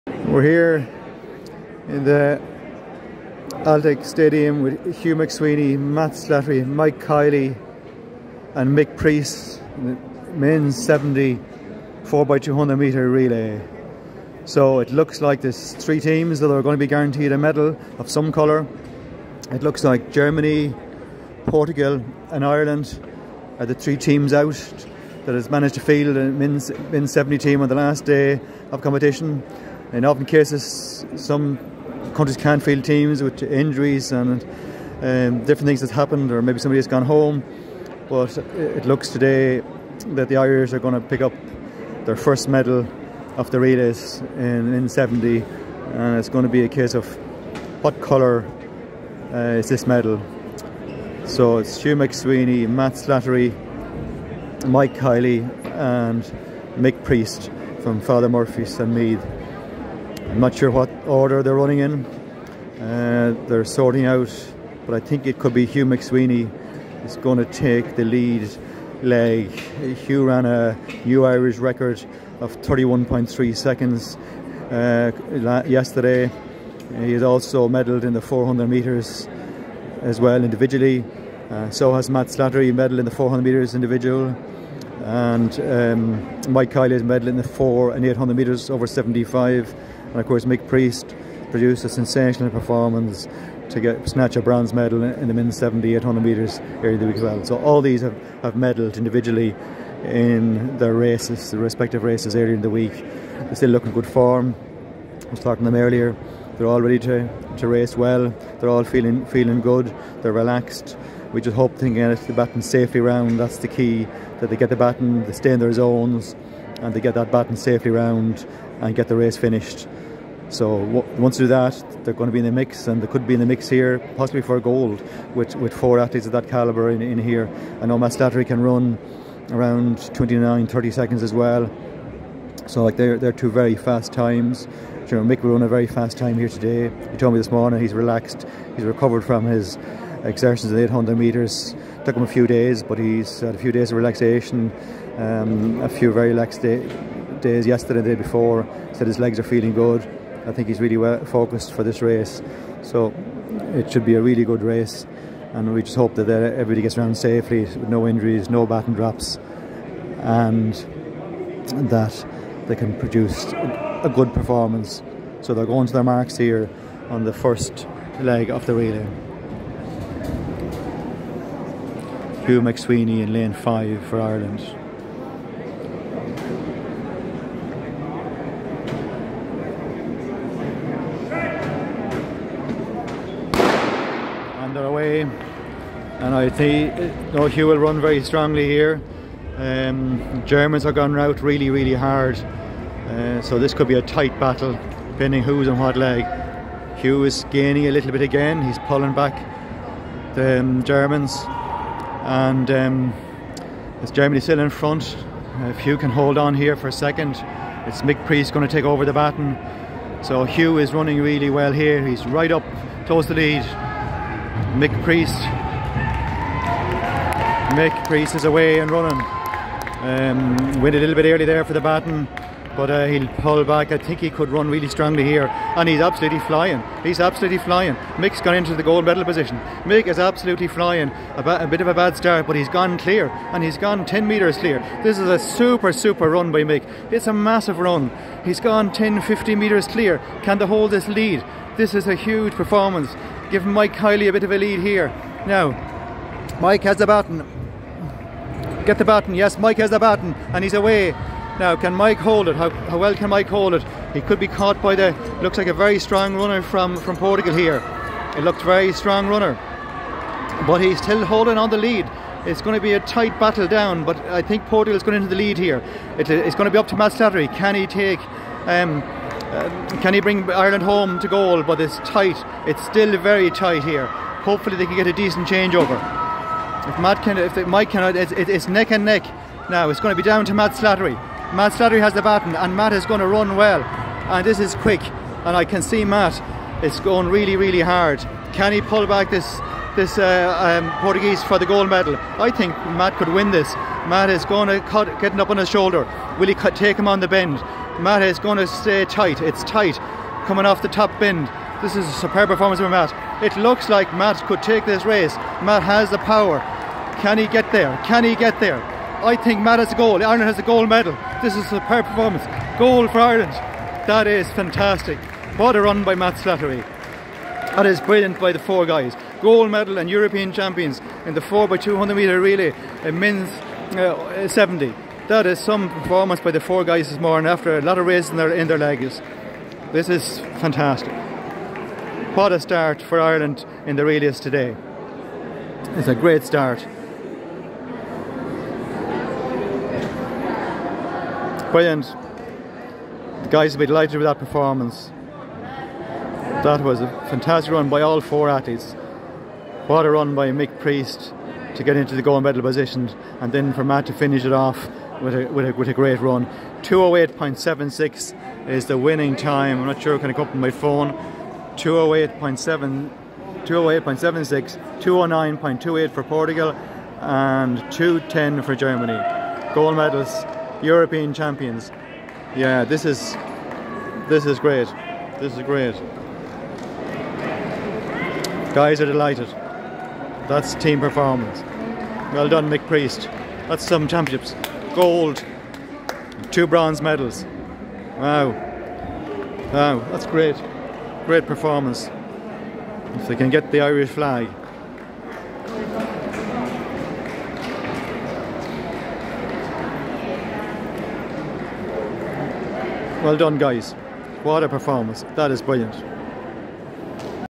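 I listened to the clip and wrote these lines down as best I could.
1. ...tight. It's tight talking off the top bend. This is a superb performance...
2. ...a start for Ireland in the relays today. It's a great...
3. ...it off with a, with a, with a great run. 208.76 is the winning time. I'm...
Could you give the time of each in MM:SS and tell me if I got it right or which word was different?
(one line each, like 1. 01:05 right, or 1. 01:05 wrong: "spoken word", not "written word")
1. 04:59 wrong: "coming", not "talking"
2. 05:32 right
3. 05:54 right.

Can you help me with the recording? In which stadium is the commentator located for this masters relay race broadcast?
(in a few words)
Aldec Stadium.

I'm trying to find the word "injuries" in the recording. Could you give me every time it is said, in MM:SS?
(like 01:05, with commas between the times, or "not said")
00:33, 02:38.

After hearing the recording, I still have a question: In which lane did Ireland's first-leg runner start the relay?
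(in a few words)
Lane 5.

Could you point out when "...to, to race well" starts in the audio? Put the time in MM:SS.
01:46.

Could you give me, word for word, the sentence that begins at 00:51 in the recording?
So it's Hugh McSweeney, Matt Slattery, Mike Kiley, and Mick Priest from Father Murphy's and Meath.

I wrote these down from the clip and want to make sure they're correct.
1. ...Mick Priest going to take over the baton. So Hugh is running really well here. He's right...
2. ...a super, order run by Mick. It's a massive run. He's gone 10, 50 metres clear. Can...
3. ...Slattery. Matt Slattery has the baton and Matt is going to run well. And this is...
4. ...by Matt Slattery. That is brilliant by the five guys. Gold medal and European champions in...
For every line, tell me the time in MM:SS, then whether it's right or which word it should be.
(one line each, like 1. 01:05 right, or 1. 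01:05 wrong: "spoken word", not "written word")
1. 03:28 right
2. 03:55 wrong: "super", not "order"
3. 04:40 right
4. 05:16 wrong: "four", not "five".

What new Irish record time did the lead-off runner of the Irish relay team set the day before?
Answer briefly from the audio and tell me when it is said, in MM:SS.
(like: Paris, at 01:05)
31.3 seconds, at 01:12.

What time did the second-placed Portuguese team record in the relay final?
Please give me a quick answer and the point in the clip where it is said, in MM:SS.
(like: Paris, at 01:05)
2:09.28, at 06:05.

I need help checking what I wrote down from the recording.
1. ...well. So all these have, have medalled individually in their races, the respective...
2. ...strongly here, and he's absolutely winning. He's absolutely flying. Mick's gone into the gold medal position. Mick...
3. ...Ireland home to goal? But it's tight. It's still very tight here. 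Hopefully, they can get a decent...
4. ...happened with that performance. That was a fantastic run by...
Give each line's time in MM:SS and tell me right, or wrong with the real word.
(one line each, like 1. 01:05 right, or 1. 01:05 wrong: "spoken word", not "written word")
1. 01:37 right
2. 03:44 wrong: "flying", not "winning"
3. 04:30 right
4. 05:43 wrong: "delighted", not "happened".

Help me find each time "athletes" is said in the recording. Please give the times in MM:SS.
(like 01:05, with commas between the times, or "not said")
02:05, 05:48.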